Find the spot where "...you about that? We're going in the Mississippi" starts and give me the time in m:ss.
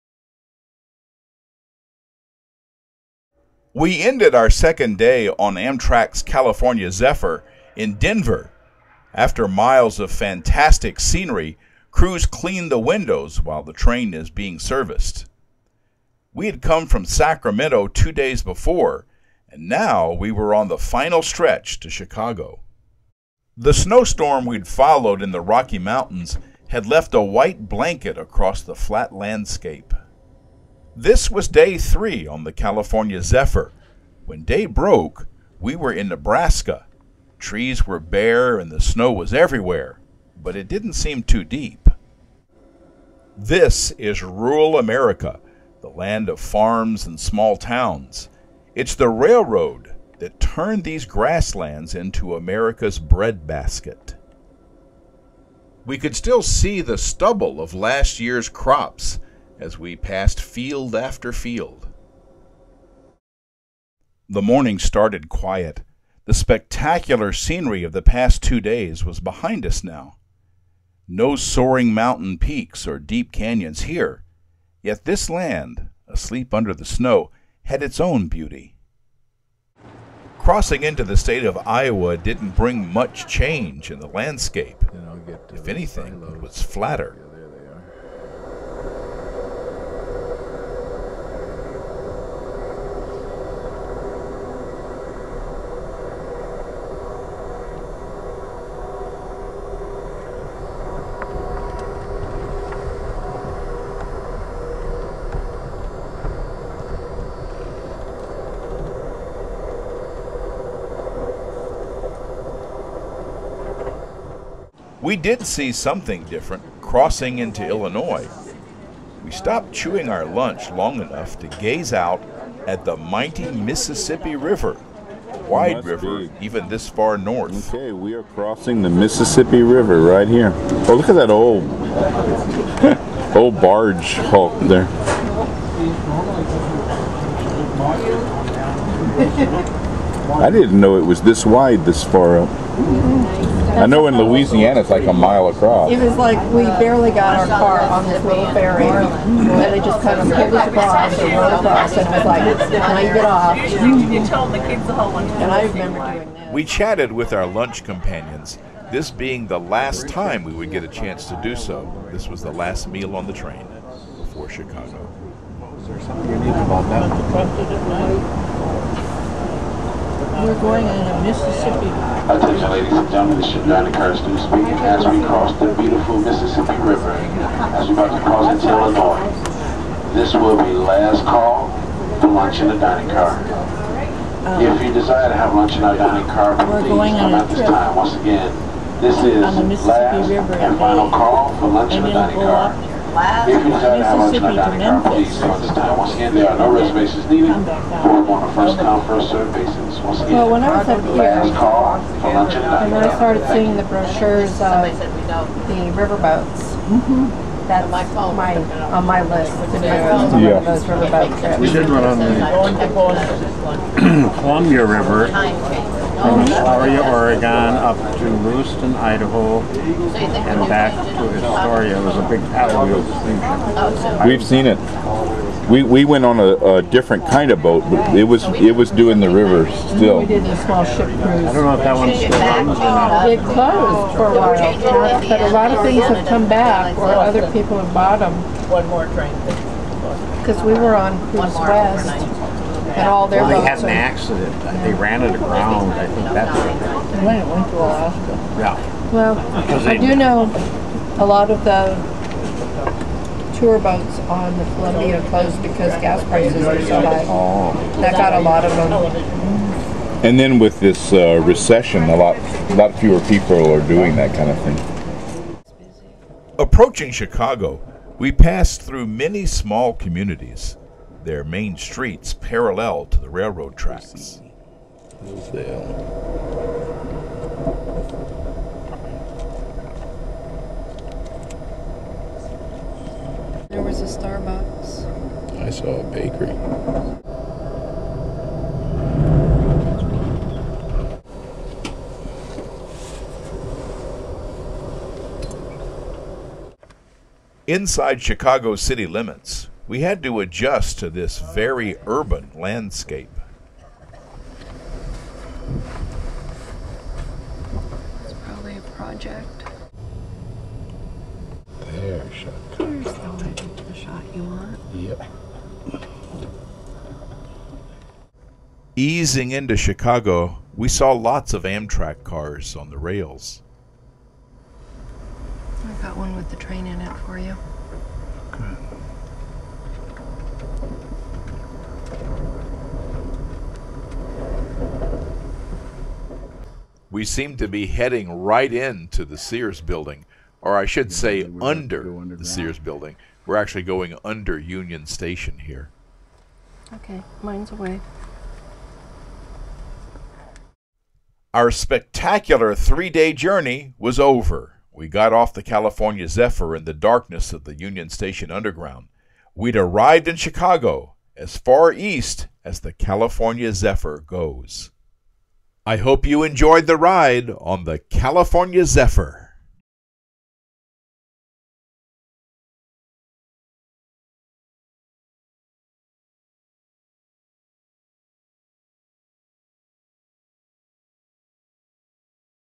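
2:46.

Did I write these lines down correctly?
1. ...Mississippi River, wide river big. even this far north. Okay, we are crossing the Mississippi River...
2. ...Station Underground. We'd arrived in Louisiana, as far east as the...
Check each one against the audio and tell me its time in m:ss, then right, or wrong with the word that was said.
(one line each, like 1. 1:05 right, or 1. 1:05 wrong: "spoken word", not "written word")
1. 2:03 right
2. 5:58 wrong: "Chicago", not "Louisiana".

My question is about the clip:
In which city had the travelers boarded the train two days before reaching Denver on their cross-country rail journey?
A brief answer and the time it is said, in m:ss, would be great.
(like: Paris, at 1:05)
Sacramento, at 0:17.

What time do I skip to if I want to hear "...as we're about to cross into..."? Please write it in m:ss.
2:57.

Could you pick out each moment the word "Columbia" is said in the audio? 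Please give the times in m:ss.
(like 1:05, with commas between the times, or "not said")
3:34, 4:14.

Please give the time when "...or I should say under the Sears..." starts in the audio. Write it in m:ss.
5:40.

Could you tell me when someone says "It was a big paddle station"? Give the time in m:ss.
3:41.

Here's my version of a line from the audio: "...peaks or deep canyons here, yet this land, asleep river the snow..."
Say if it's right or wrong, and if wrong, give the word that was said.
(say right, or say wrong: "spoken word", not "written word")
wrong: "under", not "river".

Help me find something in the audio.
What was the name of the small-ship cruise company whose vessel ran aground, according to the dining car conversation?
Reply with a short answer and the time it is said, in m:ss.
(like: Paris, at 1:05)
Cruise West, at 4:01.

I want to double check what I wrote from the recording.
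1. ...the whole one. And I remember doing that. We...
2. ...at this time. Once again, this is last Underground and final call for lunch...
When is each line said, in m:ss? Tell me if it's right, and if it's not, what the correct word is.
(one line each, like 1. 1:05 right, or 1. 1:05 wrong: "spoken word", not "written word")
1. 2:34 right
2. 3:07 wrong: "River", not "Underground".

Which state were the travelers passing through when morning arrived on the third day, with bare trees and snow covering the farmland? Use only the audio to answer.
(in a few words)
Nebraska.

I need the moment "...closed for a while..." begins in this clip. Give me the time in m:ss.
3:53.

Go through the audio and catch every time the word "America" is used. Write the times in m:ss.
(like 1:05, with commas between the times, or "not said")
0:44, 0:52.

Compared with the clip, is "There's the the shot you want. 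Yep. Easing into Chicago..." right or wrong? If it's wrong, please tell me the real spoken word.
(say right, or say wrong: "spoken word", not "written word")
right.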